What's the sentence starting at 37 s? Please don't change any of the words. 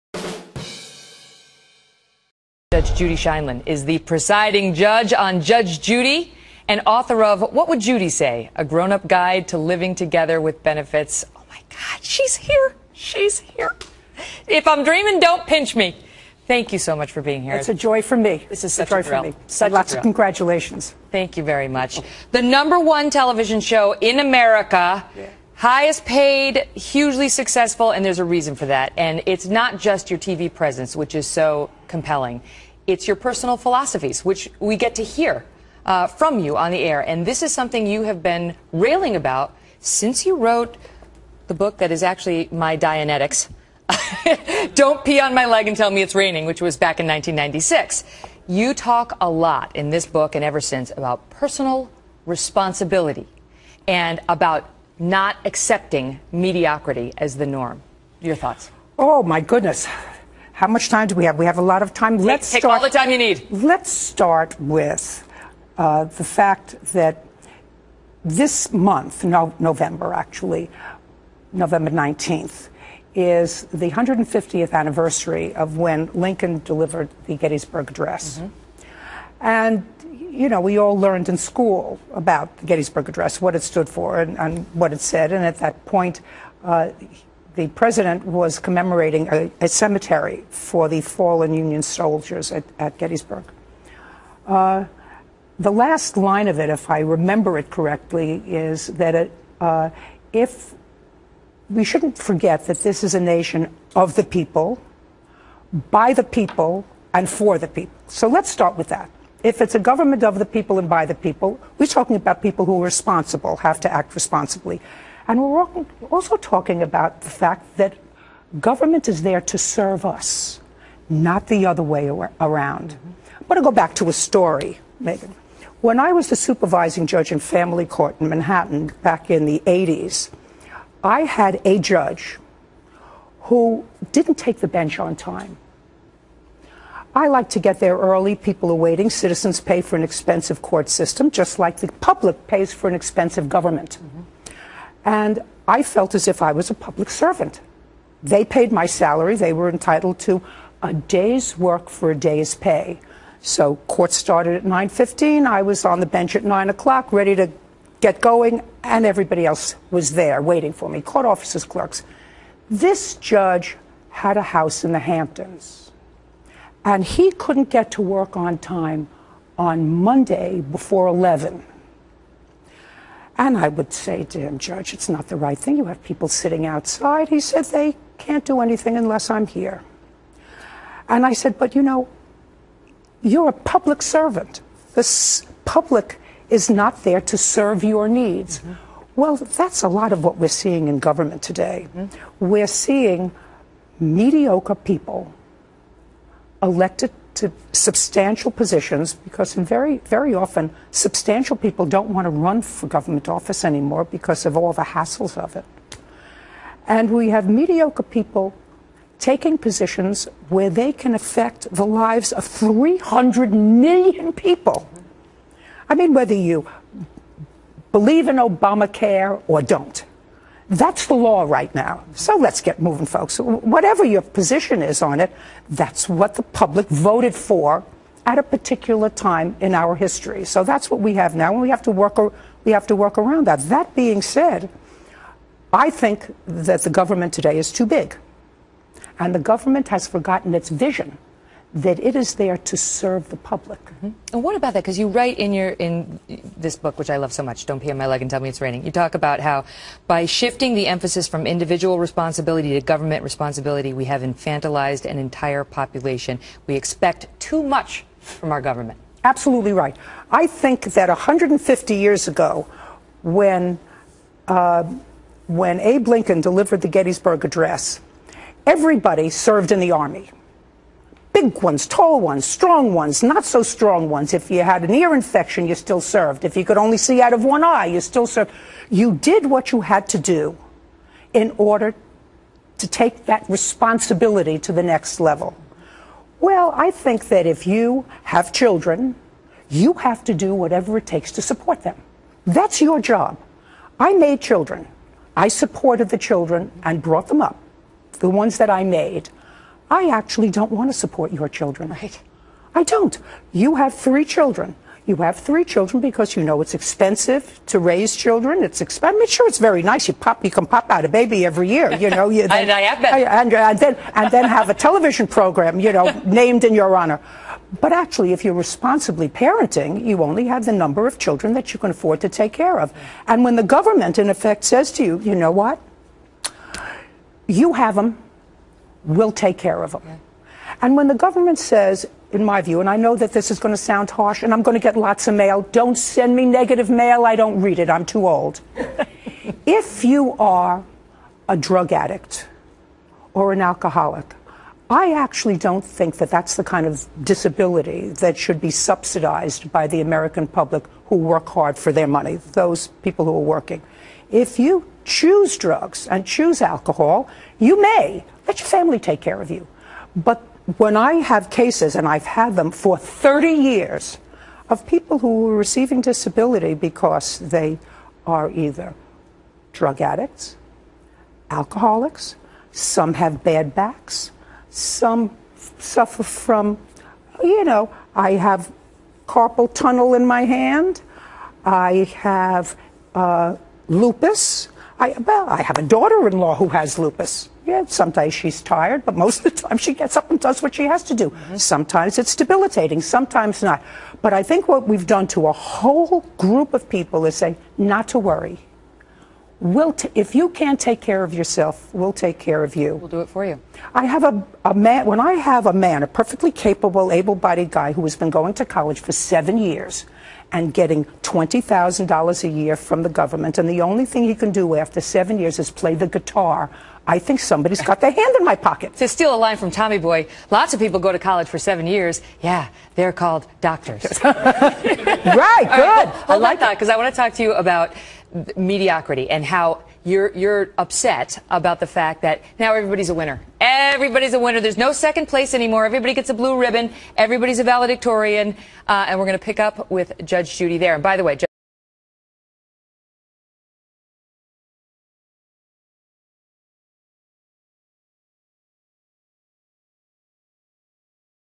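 And this is something you have been railing about since you wrote the book that is actually my Dianetics.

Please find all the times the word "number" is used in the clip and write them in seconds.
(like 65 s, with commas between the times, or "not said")
22 s, 320 s.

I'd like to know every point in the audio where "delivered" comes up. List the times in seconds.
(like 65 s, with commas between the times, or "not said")
76 s, 266 s.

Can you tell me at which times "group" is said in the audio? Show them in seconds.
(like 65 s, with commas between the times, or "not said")
396 s.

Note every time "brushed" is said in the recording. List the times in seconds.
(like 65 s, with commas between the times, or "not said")
not said.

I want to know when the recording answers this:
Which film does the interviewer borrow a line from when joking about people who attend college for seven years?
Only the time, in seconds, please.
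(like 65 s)
419 s.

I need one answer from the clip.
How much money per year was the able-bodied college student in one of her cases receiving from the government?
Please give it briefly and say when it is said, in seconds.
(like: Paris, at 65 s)
$20,000, at 411 s.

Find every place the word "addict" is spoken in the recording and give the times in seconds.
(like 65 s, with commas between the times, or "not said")
341 s, 370 s.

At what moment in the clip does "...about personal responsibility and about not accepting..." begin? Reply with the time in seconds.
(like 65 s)
50 s.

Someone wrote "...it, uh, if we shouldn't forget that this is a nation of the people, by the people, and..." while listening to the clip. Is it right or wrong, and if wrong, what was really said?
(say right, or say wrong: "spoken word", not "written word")
right.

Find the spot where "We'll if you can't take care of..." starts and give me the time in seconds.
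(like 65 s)
399 s.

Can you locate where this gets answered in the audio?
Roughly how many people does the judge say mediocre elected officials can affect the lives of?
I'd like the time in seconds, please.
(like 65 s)
212 s.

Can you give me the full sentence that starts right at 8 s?
A Grown Up Guide to Living Together with Benefits.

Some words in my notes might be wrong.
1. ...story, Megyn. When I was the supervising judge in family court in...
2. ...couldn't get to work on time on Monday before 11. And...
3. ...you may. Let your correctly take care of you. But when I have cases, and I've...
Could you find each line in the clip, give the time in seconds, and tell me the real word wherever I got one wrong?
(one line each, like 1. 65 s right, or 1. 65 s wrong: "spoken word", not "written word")
1. 124 s right
2. 167 s right
3. 357 s wrong: "family", not "correctly".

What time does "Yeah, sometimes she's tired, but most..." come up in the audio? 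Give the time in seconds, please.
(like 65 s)
387 s.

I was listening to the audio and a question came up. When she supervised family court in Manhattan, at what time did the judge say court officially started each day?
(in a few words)
9:15.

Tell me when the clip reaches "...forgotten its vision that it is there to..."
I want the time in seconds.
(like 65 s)
240 s.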